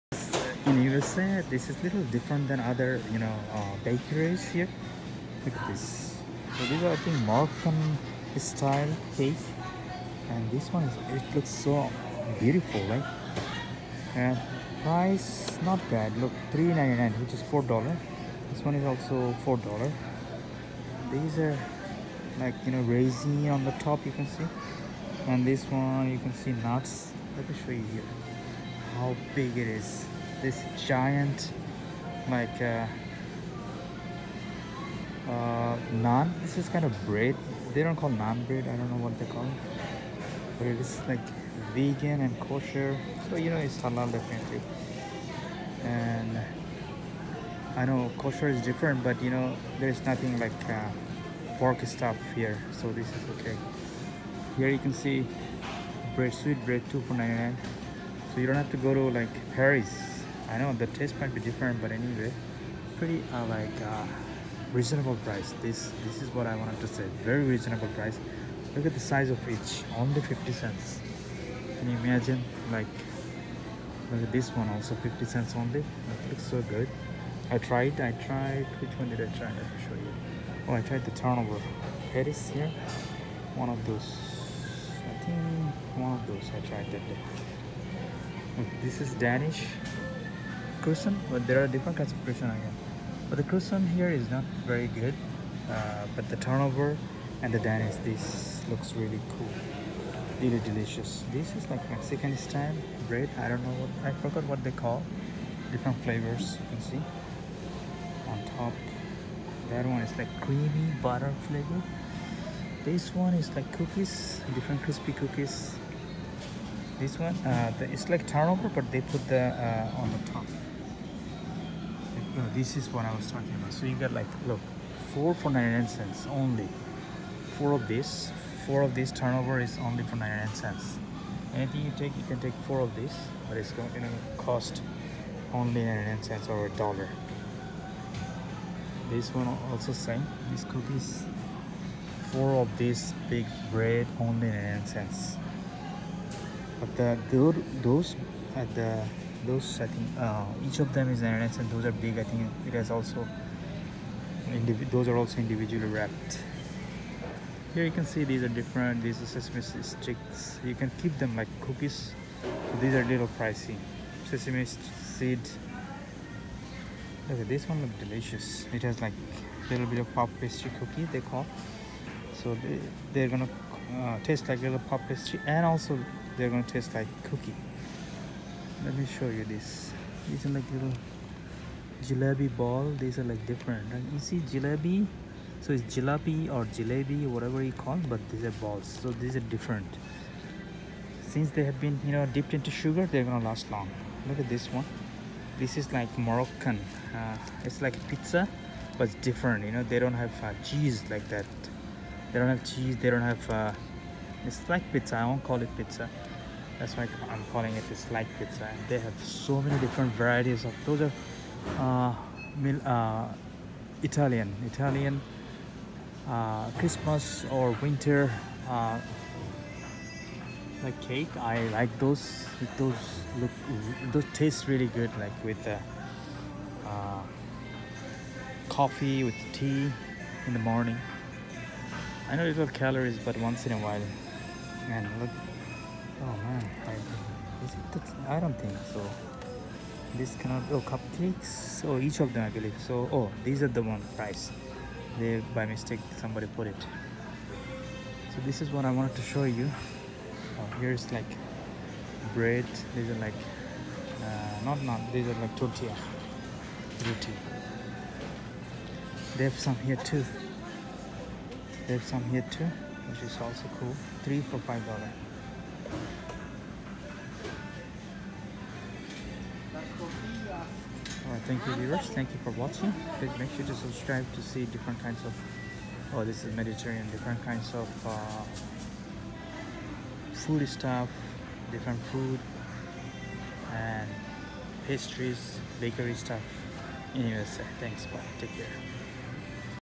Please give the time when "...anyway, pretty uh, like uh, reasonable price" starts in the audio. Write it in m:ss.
1:01.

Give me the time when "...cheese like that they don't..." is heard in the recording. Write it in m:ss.
3:20.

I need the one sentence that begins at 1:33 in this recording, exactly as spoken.
But the Croissant here is not very good, uh, but the turnover and the dynasty, this looks really cool.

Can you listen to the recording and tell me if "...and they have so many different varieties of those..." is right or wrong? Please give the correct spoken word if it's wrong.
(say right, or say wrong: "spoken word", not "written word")
right.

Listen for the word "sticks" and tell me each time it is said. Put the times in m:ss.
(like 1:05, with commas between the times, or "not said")
2:39.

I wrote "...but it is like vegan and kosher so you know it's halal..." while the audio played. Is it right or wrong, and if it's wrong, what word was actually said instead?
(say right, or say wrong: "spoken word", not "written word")
right.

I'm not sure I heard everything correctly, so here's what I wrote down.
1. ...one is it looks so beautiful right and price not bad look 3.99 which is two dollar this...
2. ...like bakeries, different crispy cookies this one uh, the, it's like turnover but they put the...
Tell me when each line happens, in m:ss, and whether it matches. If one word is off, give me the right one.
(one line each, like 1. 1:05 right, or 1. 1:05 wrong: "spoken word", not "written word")
1. 0:10 wrong: "four", not "two"
2. 1:53 wrong: "cookies", not "bakeries".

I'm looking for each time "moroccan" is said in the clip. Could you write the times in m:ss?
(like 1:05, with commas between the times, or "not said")
0:07, 3:16.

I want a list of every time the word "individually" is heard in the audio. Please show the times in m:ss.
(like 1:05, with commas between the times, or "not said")
2:35.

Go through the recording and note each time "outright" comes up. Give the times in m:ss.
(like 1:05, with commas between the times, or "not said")
not said.